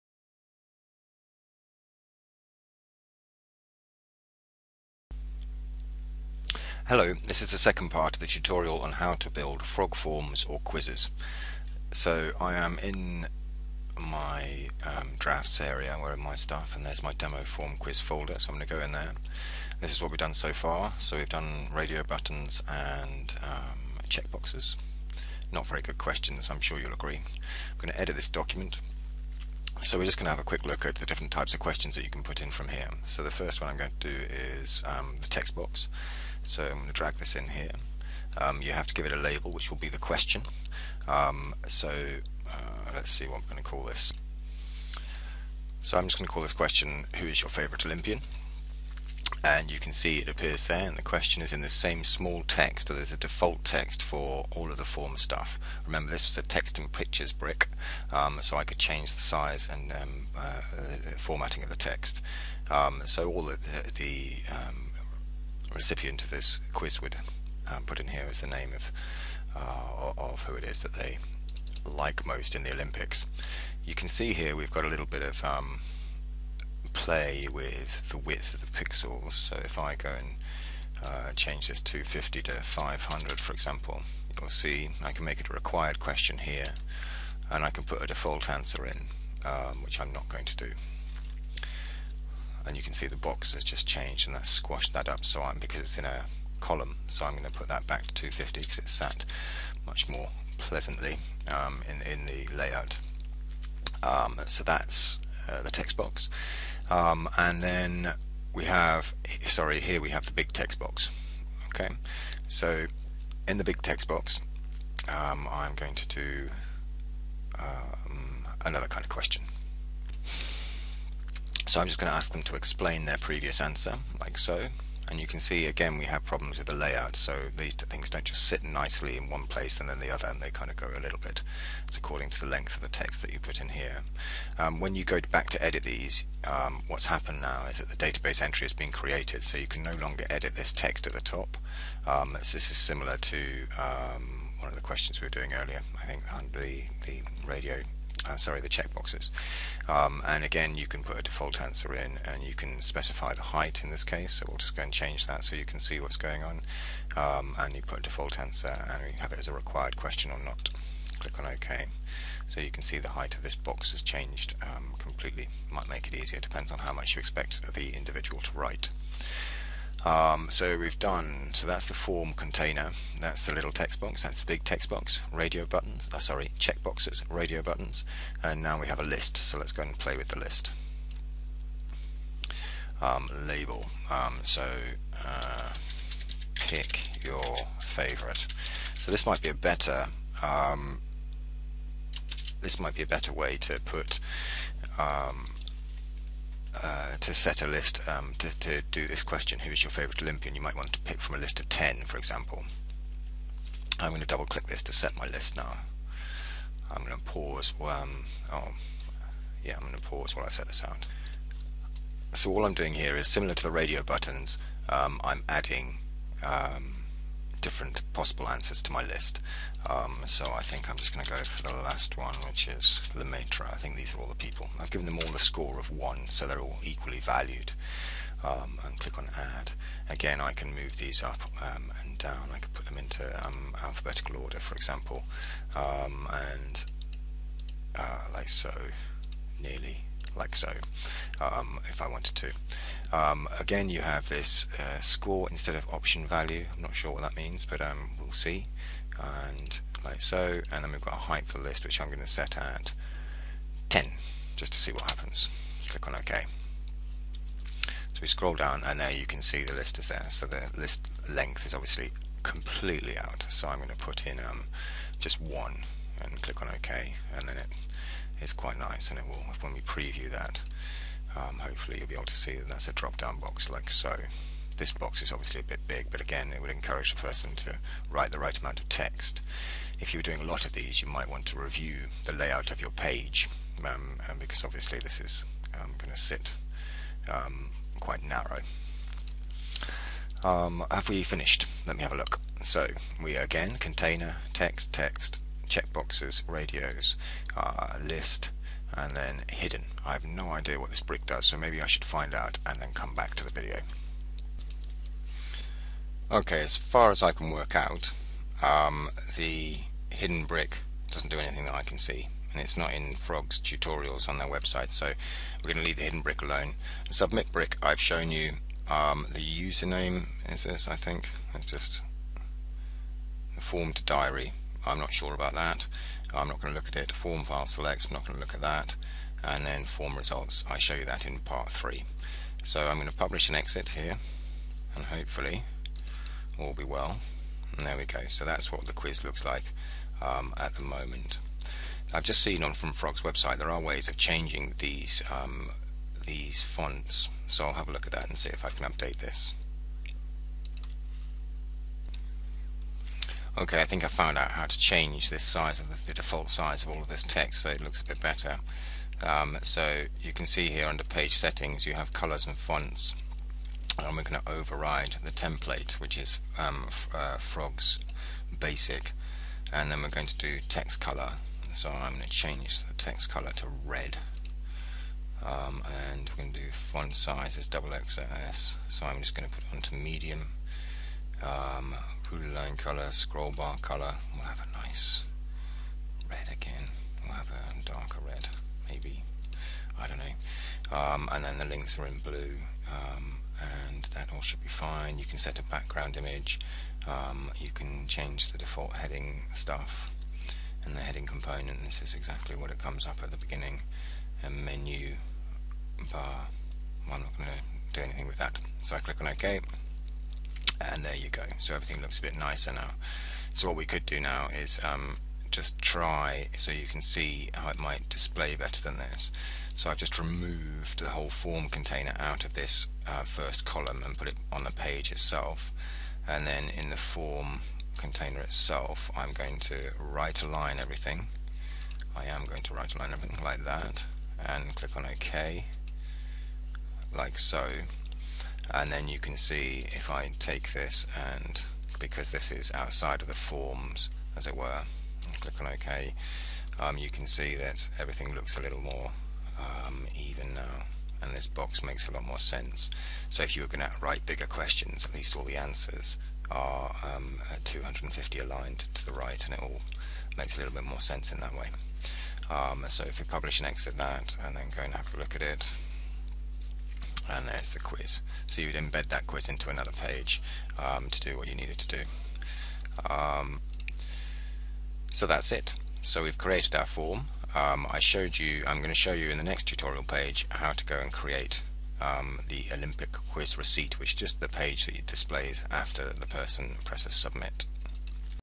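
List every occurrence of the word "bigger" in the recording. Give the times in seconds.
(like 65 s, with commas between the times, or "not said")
454 s.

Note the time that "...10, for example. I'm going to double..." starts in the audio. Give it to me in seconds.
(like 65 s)
201 s.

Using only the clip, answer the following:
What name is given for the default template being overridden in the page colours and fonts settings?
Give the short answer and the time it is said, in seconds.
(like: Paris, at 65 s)
Frogs basic, at 367 s.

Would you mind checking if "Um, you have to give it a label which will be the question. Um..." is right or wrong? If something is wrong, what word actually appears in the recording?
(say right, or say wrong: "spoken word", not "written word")
right.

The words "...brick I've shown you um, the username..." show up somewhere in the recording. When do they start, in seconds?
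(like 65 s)
317 s.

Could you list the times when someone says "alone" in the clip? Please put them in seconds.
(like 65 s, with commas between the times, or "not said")
316 s.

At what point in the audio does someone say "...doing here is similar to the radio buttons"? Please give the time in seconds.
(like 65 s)
212 s.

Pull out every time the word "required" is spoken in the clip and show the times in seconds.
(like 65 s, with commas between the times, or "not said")
85 s, 159 s.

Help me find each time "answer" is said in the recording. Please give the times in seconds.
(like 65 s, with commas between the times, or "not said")
88 s, 123 s, 151 s, 158 s, 218 s, 455 s.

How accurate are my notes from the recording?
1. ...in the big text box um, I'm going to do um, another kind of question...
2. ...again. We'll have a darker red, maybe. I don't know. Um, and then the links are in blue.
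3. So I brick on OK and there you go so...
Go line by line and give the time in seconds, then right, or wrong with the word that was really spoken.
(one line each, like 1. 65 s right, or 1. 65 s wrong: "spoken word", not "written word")
1. 113 s right
2. 386 s right
3. 408 s wrong: "click", not "brick".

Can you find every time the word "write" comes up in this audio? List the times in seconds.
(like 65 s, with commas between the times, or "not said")
168 s, 278 s, 454 s.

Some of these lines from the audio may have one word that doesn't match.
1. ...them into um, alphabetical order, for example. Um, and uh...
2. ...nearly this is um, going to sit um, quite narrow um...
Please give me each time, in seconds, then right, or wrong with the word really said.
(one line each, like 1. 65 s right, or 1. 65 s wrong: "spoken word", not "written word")
1. 232 s right
2. 284 s wrong: "obviously", not "nearly".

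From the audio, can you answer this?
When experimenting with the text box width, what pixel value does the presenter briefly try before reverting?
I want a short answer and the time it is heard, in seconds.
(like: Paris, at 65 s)
500, at 82 s.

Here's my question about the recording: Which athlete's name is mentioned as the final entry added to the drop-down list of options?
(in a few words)
Lemaitre.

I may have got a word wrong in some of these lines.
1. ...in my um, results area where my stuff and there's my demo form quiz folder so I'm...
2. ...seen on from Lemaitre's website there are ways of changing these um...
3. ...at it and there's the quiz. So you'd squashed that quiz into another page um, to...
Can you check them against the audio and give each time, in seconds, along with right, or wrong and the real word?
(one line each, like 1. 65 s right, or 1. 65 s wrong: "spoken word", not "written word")
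1. 12 s wrong: "drafts", not "results"
2. 342 s wrong: "Frog", not "Lemaitre"
3. 465 s wrong: "embed", not "squashed".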